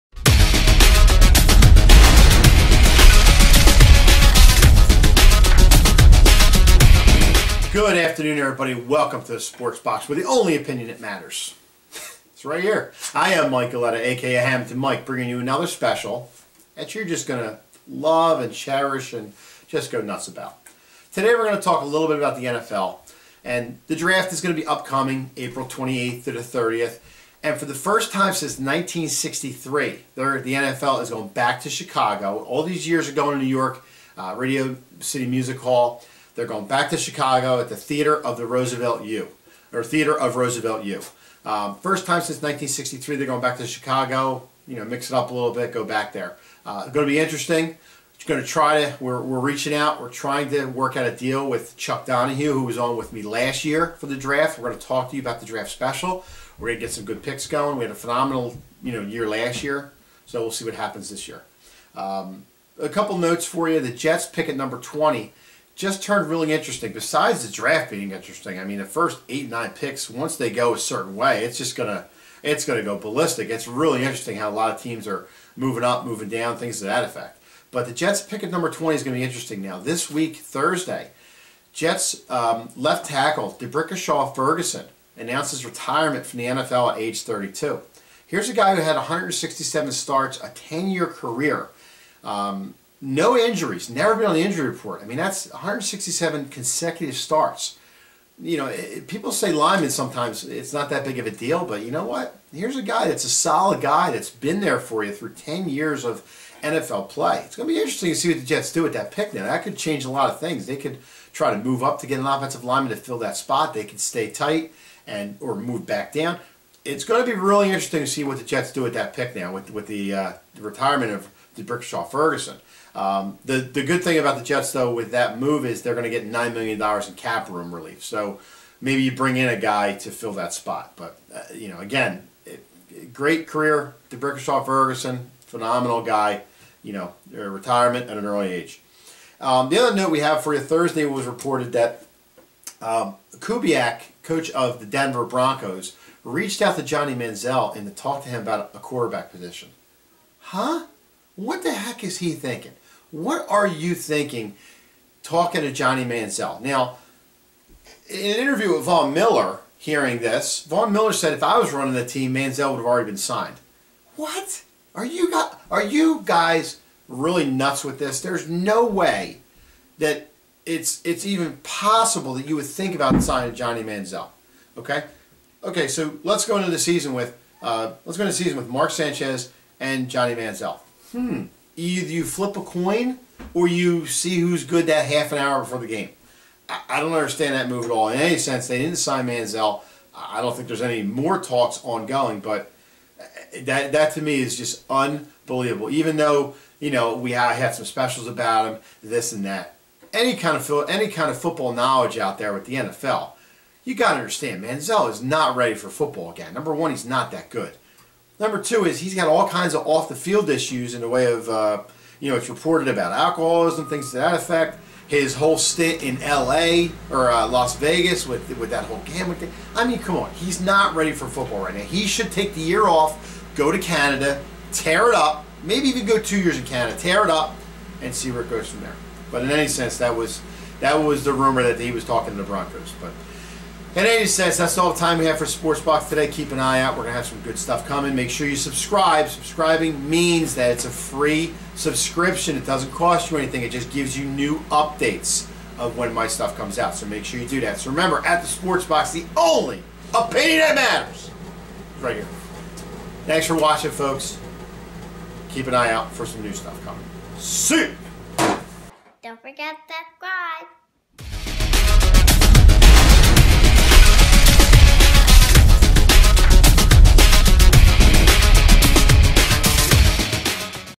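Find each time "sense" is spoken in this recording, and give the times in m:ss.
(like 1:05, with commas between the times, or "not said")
3:08, 3:49, 3:54.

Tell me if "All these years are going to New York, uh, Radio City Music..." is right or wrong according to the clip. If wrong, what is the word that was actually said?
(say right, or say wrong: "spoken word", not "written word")
right.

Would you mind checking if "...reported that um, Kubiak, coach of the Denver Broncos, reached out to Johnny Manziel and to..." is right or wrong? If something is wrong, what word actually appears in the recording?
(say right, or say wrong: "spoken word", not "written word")
right.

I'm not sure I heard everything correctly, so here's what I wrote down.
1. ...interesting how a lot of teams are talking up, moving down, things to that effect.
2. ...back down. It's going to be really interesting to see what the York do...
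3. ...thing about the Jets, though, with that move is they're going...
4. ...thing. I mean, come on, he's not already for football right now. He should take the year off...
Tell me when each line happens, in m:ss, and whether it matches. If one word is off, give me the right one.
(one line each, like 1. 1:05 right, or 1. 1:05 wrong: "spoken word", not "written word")
1. 1:14 wrong: "moving", not "talking"
2. 1:55 wrong: "Jets", not "York"
3. 2:04 right
4. 3:39 wrong: "ready", not "already".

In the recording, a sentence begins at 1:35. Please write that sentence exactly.
I mean, that's 167 consecutive starts.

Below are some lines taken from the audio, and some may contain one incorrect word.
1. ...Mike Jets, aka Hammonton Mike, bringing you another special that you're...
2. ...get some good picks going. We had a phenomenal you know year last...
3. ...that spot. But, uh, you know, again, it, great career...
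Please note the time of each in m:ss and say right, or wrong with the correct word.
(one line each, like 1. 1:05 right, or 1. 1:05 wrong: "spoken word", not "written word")
1. 0:13 wrong: "Galletta", not "Jets"
2. 0:56 right
3. 2:10 right.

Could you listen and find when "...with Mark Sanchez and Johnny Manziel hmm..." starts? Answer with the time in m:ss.
2:58.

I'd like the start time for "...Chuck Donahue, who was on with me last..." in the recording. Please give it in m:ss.
0:51.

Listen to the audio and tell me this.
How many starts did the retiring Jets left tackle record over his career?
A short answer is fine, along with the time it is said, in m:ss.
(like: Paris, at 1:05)
167, at 1:28.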